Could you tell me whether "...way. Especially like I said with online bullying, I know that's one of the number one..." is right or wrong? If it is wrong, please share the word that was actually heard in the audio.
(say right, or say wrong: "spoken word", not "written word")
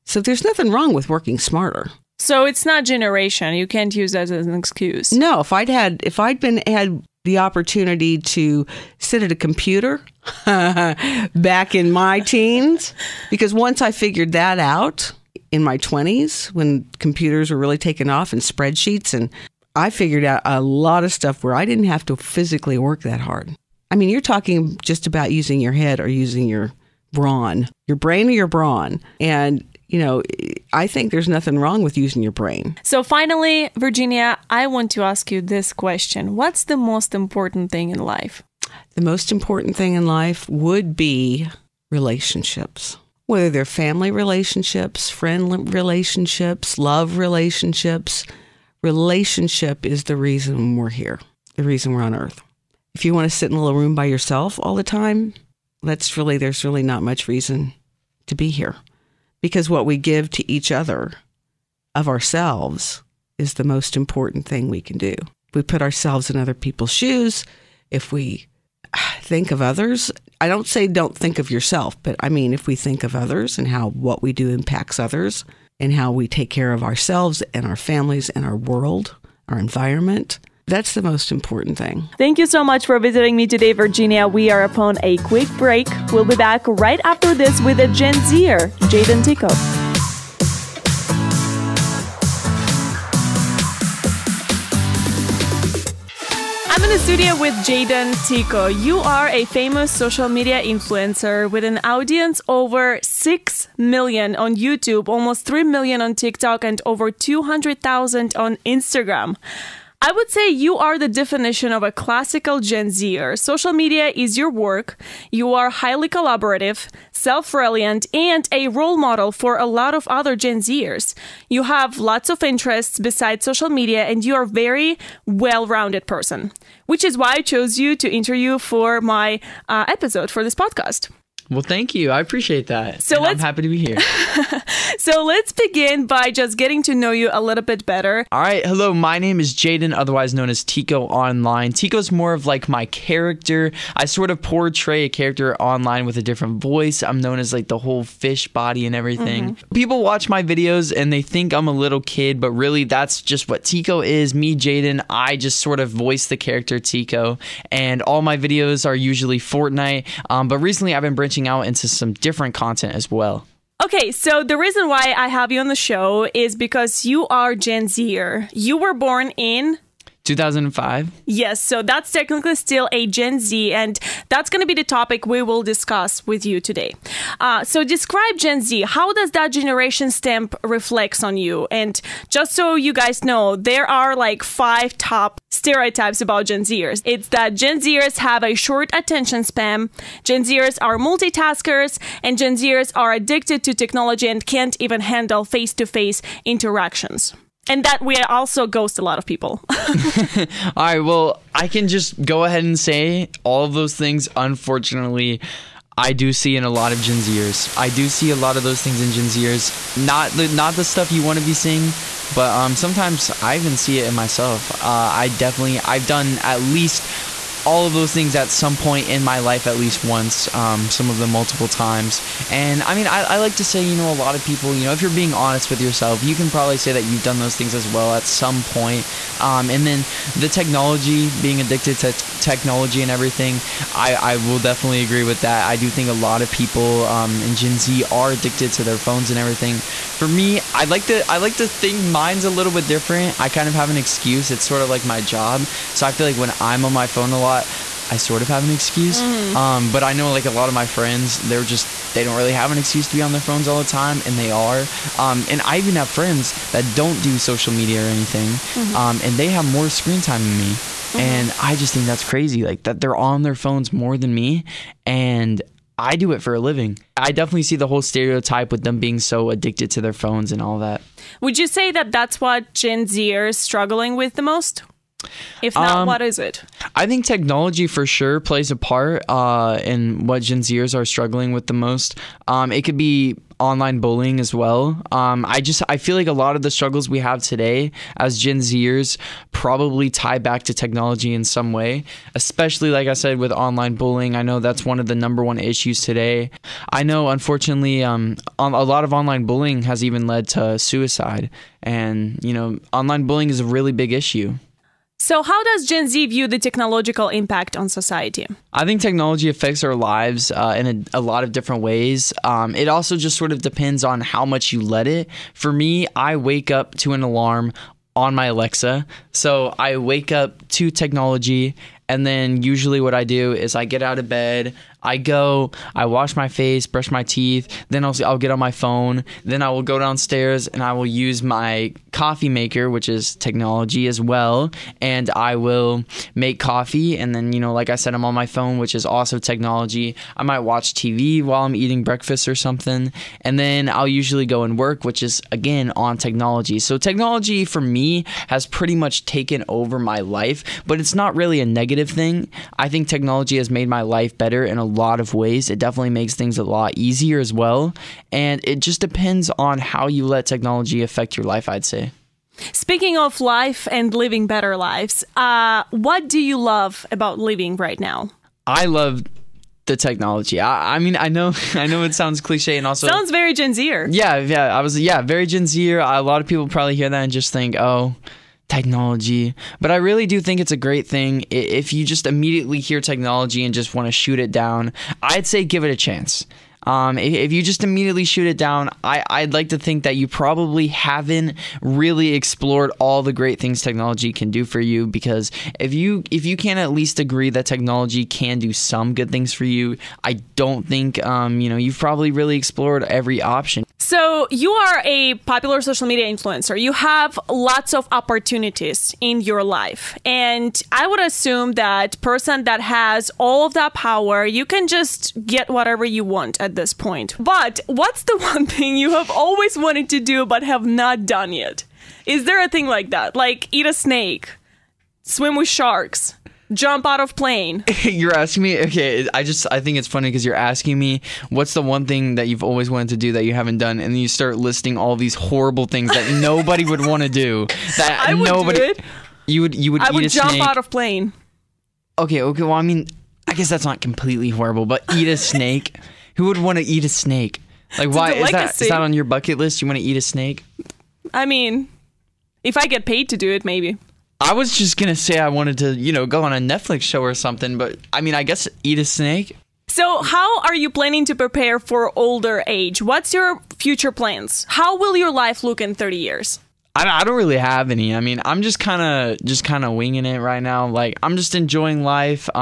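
right.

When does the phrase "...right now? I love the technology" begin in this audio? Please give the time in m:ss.
6:07.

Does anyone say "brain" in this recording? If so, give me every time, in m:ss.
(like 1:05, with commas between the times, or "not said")
0:27, 0:32.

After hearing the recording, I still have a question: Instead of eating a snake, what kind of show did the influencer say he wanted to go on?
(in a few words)
A Netflix show.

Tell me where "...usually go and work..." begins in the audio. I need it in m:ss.
5:44.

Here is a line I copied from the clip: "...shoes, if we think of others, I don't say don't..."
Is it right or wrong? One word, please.
right.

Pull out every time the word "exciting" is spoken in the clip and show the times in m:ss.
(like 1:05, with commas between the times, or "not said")
not said.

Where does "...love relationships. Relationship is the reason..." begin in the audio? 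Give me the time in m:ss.
0:46.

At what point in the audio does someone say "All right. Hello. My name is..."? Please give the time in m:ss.
2:18.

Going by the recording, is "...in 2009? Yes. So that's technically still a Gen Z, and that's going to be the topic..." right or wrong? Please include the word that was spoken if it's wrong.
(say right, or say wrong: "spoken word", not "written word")
wrong: "2005", not "2009".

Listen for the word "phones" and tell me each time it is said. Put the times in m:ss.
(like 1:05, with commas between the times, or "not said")
3:58, 4:07, 4:13, 4:23, 4:30, 5:28, 5:38.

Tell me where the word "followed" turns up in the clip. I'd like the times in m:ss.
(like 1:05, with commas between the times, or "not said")
not said.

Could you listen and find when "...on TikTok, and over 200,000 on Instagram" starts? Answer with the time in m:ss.
1:46.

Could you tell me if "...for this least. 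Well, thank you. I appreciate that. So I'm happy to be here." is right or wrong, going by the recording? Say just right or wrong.
wrong.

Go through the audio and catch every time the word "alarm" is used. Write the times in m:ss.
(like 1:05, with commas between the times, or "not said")
5:17.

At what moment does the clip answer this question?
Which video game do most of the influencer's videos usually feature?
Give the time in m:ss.
2:38.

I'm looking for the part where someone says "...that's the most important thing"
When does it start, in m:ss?
1:20.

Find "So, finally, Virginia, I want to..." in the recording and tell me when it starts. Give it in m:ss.
0:32.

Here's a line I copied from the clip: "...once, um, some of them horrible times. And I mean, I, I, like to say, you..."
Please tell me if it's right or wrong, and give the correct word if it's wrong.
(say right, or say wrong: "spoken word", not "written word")
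wrong: "multiple", not "horrible".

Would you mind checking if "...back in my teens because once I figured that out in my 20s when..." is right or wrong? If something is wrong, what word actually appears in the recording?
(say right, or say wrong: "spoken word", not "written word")
right.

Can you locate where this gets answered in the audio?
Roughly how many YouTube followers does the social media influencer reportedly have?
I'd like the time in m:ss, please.
1:42.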